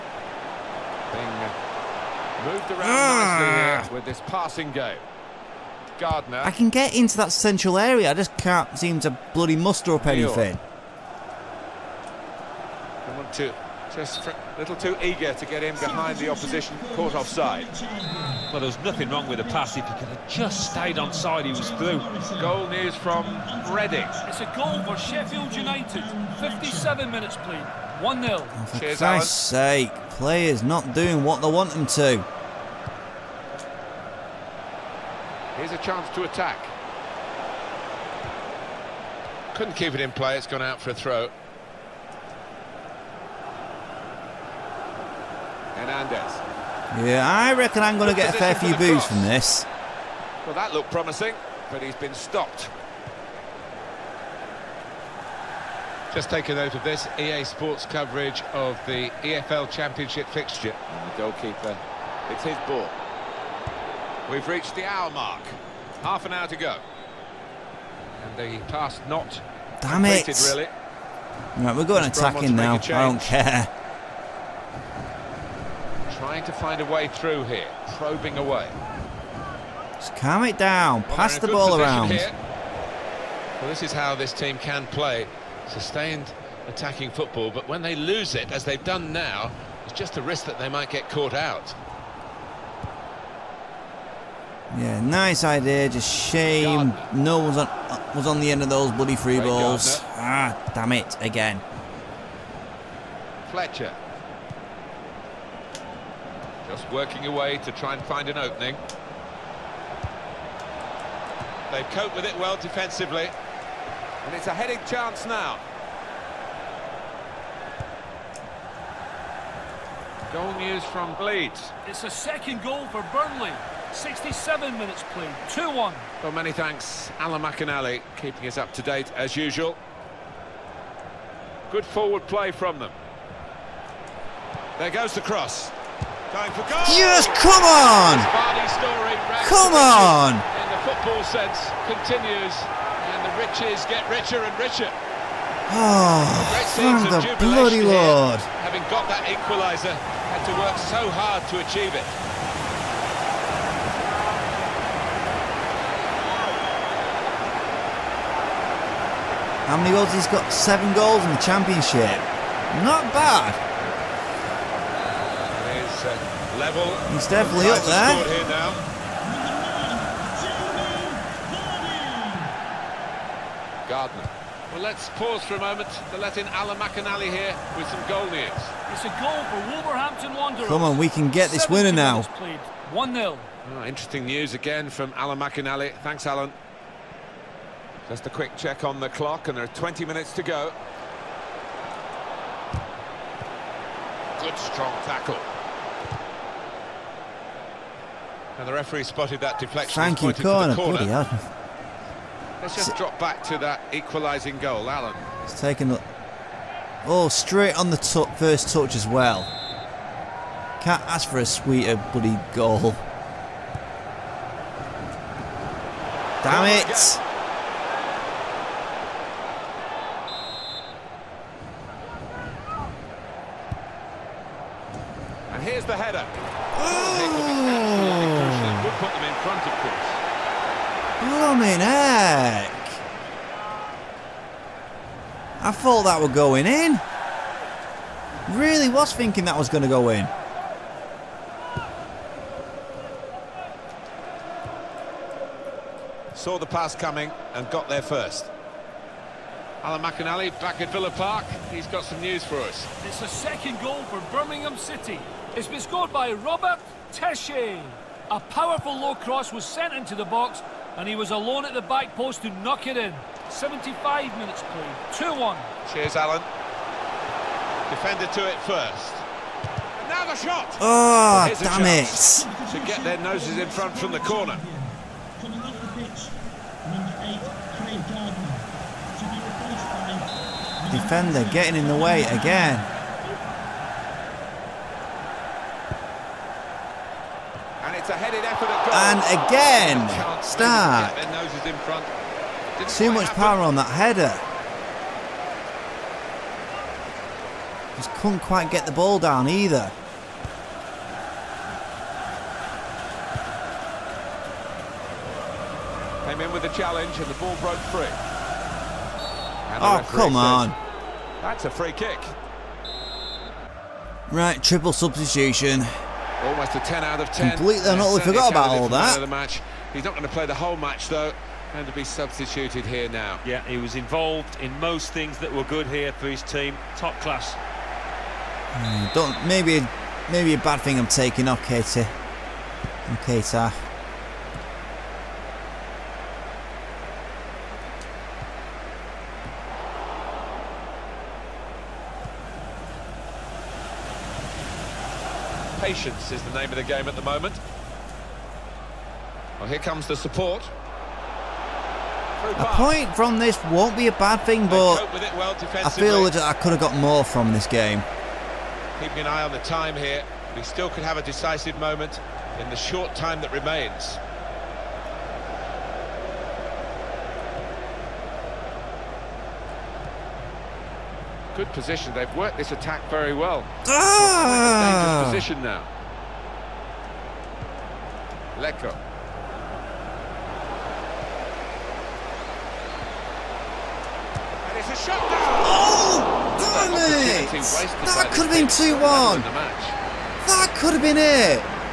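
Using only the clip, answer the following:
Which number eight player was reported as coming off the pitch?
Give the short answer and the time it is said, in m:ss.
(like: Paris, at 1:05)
Craig Gardner, at 4:37.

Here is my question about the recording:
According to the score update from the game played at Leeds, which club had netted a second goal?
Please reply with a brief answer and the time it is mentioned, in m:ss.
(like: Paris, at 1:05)
Burnley, at 2:03.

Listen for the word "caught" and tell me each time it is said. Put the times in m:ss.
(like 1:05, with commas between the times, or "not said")
0:16, 1:31.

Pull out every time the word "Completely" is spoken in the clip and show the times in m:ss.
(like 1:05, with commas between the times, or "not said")
5:17.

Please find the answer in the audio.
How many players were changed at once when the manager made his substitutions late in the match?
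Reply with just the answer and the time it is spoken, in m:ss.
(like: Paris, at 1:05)
3, at 5:14.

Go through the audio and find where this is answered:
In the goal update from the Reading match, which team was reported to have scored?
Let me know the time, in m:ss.
0:24.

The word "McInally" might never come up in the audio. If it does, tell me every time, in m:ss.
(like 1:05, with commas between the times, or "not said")
2:07, 2:56, 3:05, 4:10.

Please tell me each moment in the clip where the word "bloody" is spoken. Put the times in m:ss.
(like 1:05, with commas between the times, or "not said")
0:09, 1:38, 2:27, 3:32.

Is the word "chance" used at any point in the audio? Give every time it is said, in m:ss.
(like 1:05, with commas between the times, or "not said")
0:35, 1:54.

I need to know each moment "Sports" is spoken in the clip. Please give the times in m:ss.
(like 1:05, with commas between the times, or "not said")
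0:57.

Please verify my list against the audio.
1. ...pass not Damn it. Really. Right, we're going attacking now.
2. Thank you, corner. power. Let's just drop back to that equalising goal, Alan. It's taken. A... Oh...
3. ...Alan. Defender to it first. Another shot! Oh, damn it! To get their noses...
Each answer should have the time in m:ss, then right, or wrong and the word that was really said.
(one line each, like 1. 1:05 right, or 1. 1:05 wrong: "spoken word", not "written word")
1. 1:08 right
2. 3:20 wrong: "corner", not "power"
3. 4:26 right.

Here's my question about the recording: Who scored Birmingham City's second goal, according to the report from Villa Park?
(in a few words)
Robert Tesche.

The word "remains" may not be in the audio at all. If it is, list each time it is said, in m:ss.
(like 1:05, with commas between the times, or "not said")
6:03.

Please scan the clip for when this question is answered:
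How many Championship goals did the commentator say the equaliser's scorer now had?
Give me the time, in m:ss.
2:40.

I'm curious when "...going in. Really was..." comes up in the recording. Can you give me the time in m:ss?
3:56.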